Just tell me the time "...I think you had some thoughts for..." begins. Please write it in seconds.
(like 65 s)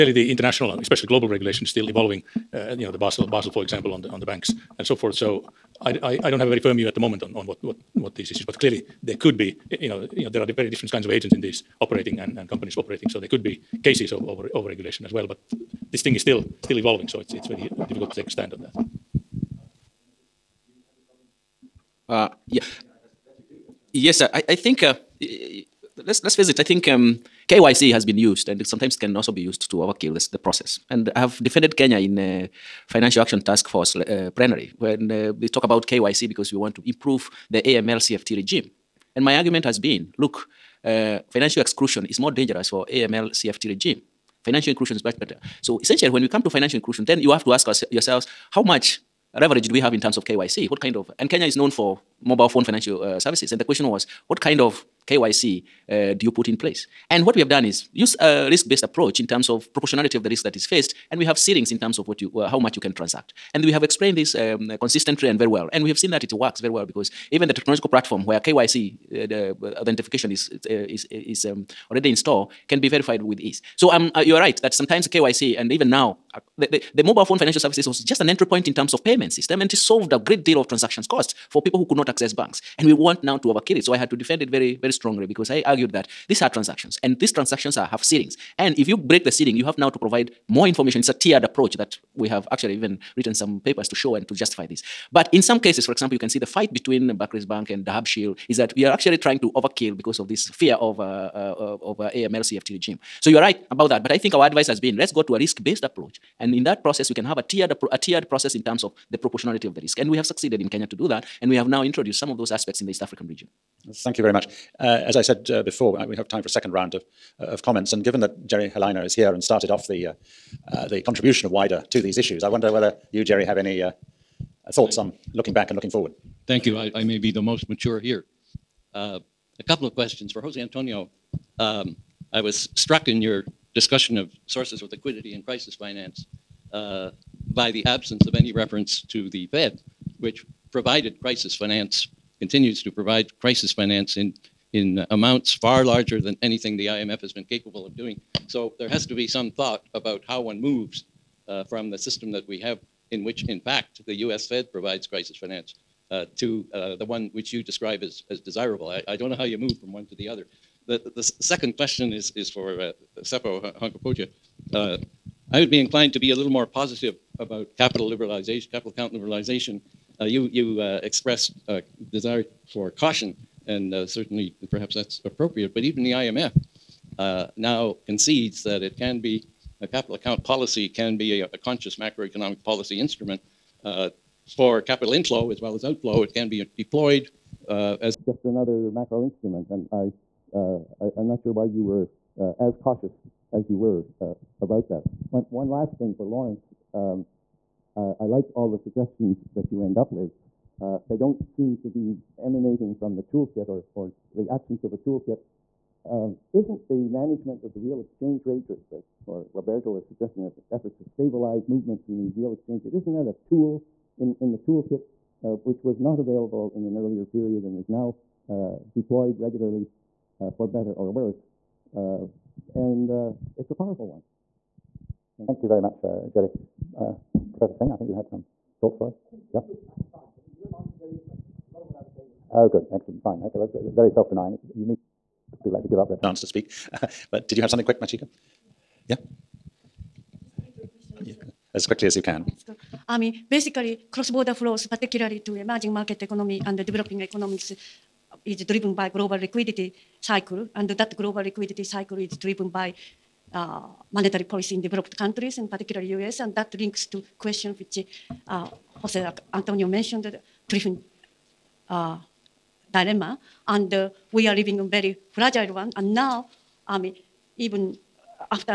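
227 s.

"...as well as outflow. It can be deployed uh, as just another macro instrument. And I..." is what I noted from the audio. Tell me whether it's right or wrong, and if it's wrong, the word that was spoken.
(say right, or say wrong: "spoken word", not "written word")
right.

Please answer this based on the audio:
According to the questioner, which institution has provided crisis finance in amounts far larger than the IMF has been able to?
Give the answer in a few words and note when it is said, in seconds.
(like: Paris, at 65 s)
the Fed, at 139 s.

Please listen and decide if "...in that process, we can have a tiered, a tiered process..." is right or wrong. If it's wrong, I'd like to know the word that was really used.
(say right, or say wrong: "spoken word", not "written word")
right.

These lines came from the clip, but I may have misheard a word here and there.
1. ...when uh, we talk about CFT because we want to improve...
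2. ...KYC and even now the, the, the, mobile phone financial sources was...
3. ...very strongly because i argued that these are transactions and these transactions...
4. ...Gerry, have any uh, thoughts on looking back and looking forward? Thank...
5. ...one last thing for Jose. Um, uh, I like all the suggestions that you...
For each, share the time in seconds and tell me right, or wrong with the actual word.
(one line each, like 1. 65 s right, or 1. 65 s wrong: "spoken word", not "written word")
1. 34 s wrong: "KYC", not "CFT"
2. 75 s wrong: "services", not "sources"
3. 84 s right
4. 123 s right
5. 195 s wrong: "Laurence", not "Jose".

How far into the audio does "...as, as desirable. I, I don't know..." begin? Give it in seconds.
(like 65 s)
158 s.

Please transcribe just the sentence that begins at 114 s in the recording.
Uh, as I said uh, before, I, we have time for a second round of, uh, of comments.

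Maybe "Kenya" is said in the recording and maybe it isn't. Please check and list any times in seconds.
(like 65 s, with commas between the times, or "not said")
31 s, 51 s, 110 s.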